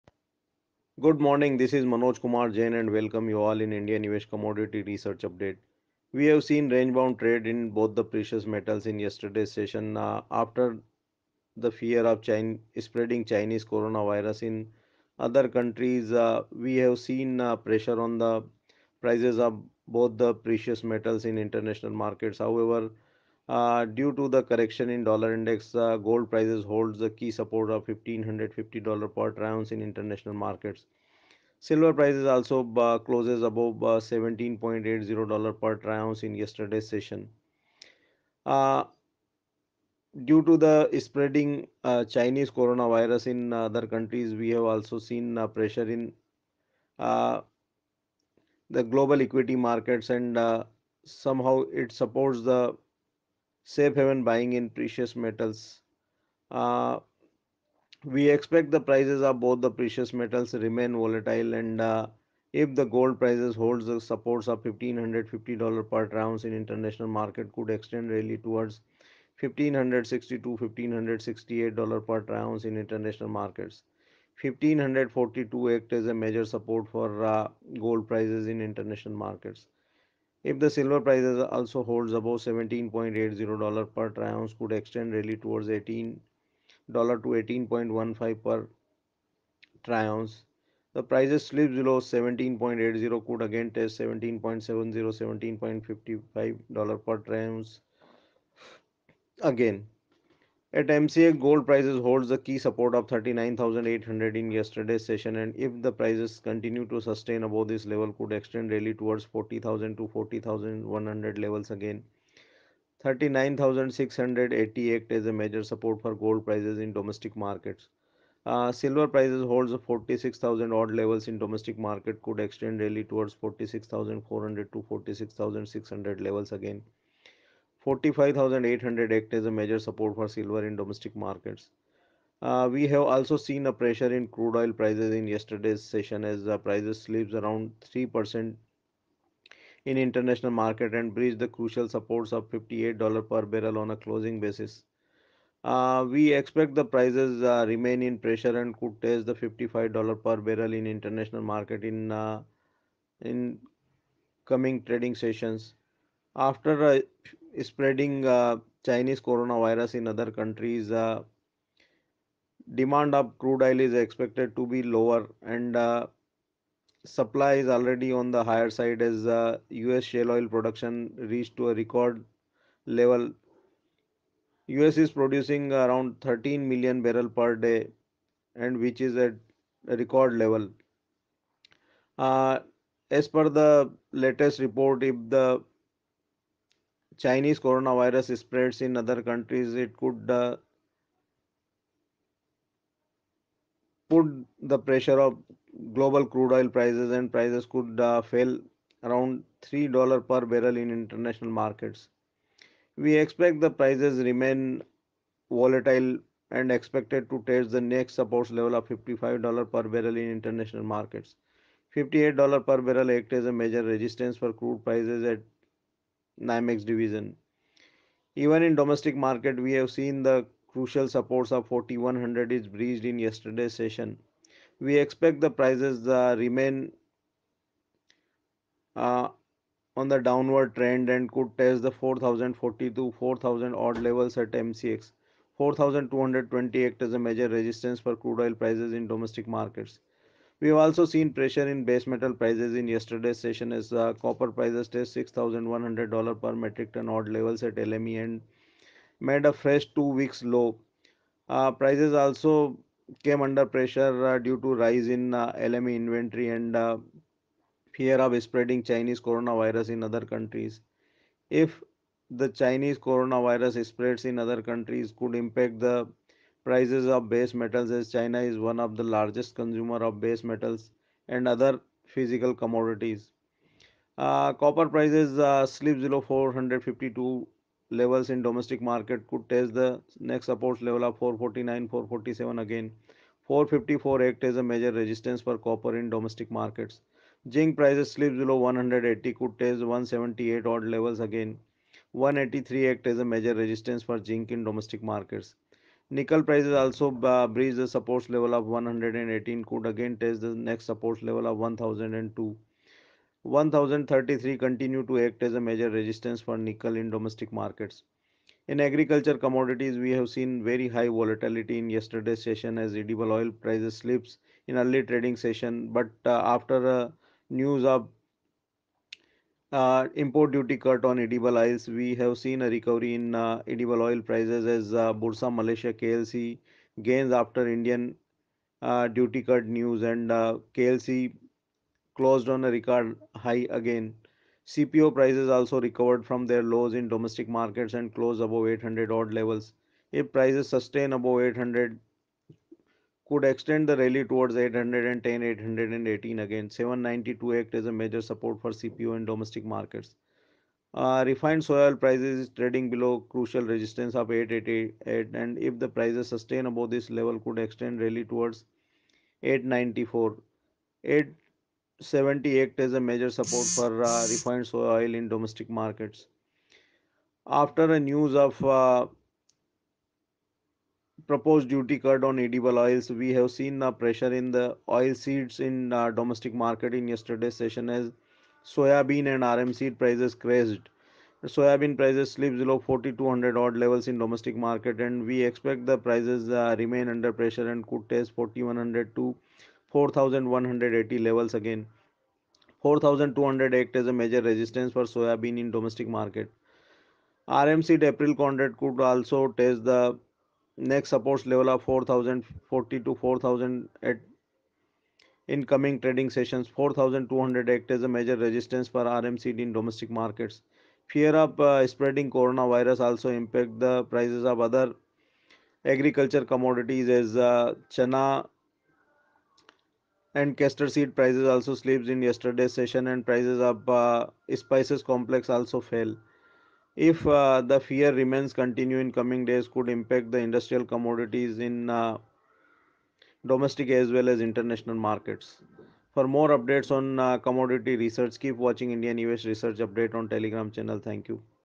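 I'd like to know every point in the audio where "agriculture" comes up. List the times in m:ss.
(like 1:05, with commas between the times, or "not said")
5:08, 6:55.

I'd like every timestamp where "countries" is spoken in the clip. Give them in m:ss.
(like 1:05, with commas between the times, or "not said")
0:15, 0:43, 2:40, 3:09, 4:20, 4:24.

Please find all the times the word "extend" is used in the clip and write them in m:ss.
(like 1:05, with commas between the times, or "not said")
1:07, 1:48, 2:02, 5:43, 5:57.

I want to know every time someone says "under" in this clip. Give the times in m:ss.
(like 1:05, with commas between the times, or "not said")
4:13, 6:27.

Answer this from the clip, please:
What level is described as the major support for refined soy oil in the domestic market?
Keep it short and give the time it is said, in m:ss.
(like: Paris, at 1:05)
870, at 6:01.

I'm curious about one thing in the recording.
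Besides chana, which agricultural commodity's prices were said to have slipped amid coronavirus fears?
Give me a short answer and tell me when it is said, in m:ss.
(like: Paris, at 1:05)
Castor seed, at 7:00.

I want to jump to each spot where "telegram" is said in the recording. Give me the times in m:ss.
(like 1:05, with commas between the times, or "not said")
7:20.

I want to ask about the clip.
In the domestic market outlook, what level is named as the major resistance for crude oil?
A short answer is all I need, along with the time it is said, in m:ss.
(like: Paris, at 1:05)
4228, at 3:55.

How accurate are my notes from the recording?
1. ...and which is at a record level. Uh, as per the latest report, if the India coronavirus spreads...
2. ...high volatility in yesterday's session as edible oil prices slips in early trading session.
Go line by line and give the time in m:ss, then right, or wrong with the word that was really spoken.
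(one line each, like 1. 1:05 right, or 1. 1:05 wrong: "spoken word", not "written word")
1. 2:58 wrong: "Chinese", not "India"
2. 5:10 right.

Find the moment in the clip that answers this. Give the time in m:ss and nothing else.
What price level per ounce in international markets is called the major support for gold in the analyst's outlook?
1:14.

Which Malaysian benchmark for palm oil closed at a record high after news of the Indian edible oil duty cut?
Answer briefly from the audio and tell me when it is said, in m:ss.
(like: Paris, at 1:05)
Bursa Malaysia KLC, at 5:25.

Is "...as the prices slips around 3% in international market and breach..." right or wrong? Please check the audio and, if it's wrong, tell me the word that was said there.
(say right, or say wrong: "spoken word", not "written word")
right.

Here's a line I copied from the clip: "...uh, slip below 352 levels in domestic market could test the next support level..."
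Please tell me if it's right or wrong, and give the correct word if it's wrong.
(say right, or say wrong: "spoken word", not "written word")
wrong: "452", not "352".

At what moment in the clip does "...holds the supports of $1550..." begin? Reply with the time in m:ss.
1:03.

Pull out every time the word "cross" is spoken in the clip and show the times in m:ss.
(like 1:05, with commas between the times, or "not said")
not said.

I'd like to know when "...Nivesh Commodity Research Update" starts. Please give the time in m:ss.
0:03.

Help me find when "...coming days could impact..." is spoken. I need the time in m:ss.
7:09.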